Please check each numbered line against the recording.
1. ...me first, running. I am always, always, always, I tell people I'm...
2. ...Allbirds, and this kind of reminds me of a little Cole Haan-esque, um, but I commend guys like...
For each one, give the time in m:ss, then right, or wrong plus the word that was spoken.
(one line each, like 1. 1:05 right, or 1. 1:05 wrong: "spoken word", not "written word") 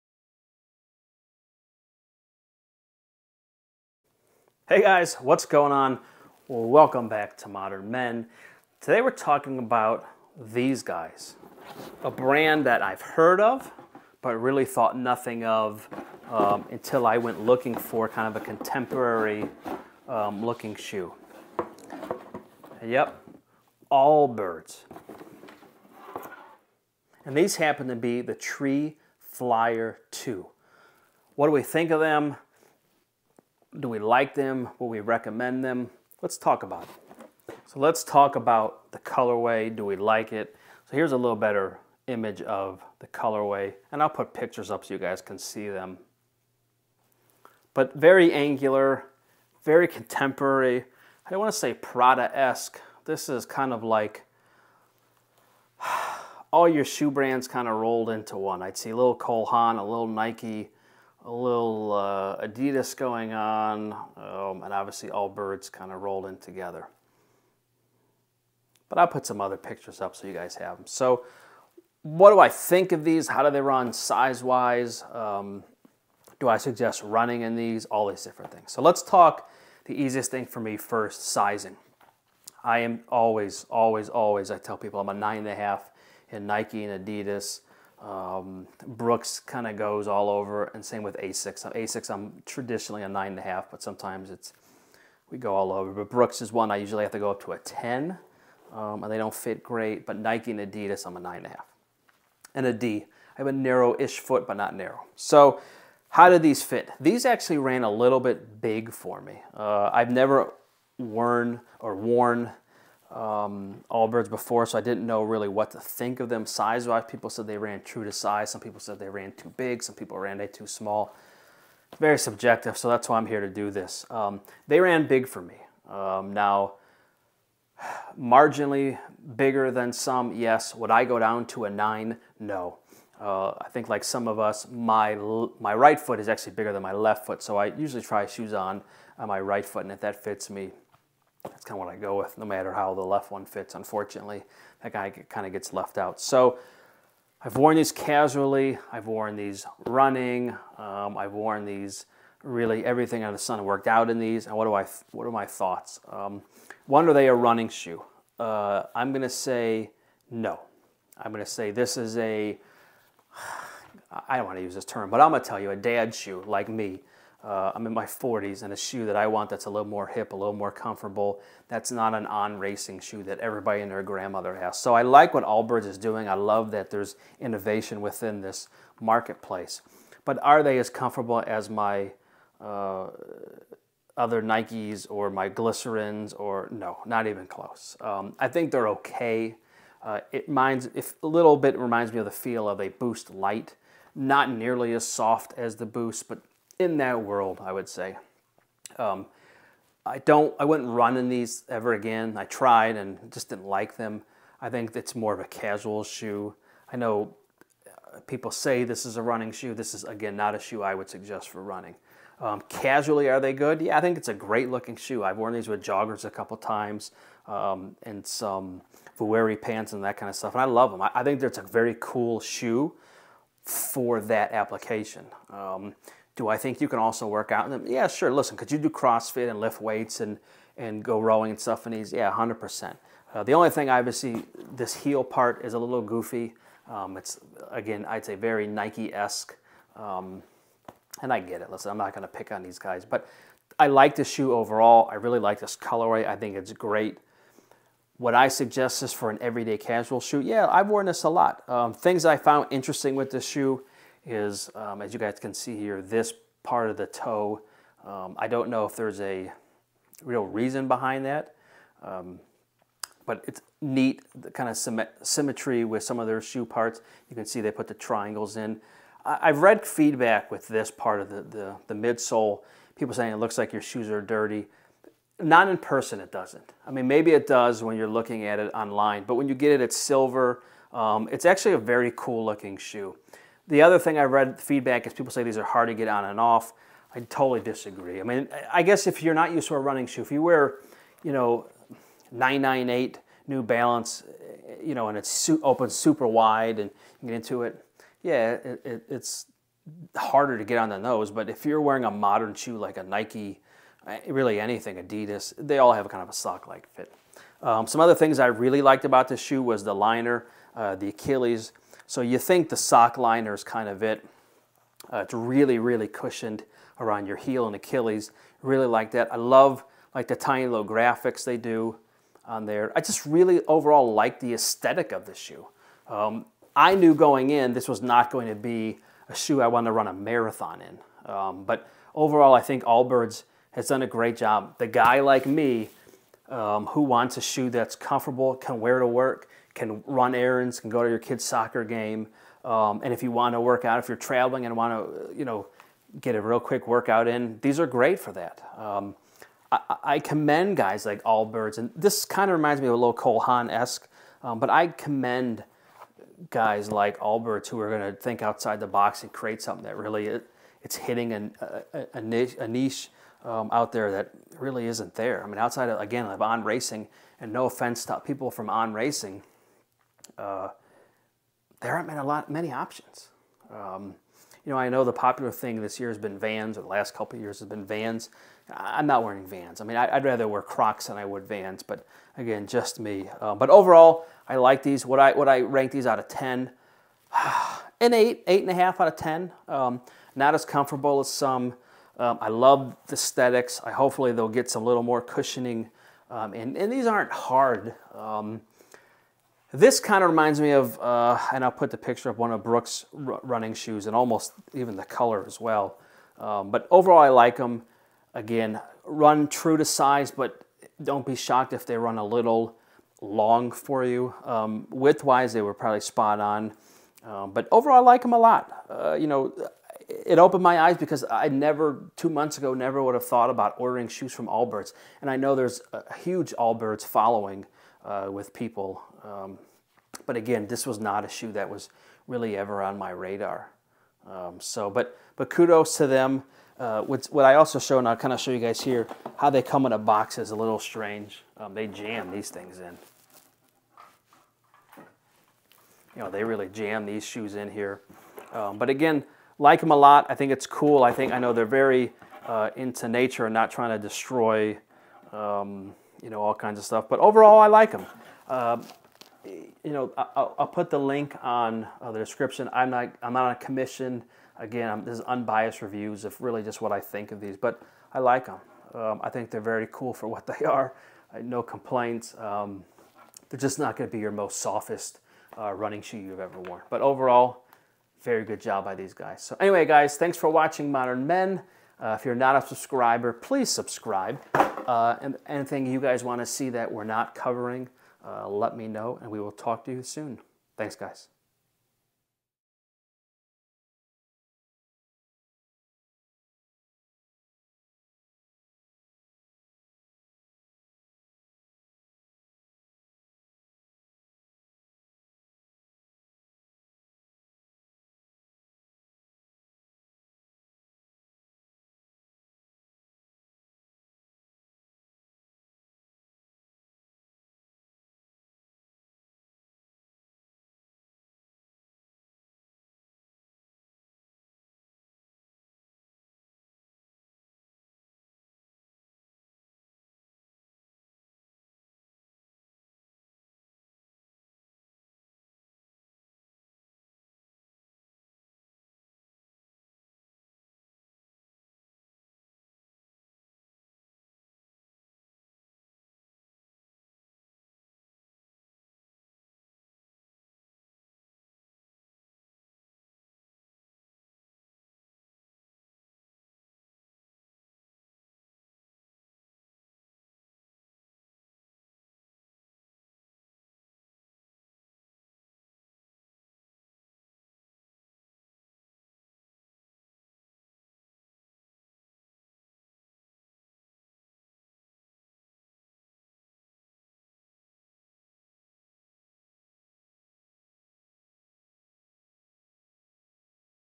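1. 1:20 wrong: "sizing", not "running"
2. 5:51 right.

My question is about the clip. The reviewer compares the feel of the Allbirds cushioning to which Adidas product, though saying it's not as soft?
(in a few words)
Boost Light.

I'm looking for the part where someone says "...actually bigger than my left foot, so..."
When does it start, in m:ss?
2:16.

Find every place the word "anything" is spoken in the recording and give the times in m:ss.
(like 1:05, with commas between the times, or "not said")
5:04, 8:05.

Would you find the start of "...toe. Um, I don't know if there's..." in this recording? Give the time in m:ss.
4:17.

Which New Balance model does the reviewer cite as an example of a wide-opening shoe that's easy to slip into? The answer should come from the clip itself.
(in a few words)
998.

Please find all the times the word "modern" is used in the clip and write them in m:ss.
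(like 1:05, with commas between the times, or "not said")
0:07, 5:02, 8:00.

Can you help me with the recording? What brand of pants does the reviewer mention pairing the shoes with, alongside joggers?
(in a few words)
Vuori.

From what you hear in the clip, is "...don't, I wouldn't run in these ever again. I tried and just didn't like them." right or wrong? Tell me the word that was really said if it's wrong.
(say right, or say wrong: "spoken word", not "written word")
right.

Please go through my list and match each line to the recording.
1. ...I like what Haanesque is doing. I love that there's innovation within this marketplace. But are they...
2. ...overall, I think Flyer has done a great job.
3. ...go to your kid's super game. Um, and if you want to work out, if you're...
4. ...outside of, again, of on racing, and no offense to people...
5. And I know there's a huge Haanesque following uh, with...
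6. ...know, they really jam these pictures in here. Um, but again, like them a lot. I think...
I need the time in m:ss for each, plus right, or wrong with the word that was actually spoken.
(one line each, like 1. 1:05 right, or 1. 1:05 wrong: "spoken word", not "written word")
1. 2:54 wrong: "Allbirds", not "Haanesque"
2. 5:32 wrong: "Allbirds", not "Flyer"
3. 5:40 wrong: "soccer", not "super"
4. 6:05 right
5. 7:05 wrong: "Allbirds", not "Haanesque"
6. 7:26 wrong: "shoes", not "pictures".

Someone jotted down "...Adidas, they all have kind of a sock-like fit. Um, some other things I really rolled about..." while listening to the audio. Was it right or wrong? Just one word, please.
wrong.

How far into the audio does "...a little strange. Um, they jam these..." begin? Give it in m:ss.
7:20.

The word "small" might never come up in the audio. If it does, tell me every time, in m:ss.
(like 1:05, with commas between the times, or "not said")
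2:00.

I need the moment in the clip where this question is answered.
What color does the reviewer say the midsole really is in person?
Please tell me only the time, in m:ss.
4:39.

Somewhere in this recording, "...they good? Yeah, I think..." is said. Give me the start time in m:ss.
3:33.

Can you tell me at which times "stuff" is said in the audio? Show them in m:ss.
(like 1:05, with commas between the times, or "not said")
3:40, 3:51, 7:36.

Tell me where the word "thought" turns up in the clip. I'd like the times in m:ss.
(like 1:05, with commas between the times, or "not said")
0:14, 2:35, 7:03.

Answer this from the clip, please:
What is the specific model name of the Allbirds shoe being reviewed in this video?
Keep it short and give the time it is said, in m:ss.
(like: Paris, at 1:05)
Tree Flyer 2, at 0:28.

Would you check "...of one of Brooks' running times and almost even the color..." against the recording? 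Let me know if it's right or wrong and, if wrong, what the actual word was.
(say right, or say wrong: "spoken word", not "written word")
wrong: "shoes", not "times".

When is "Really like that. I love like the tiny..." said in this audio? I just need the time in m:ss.
5:18.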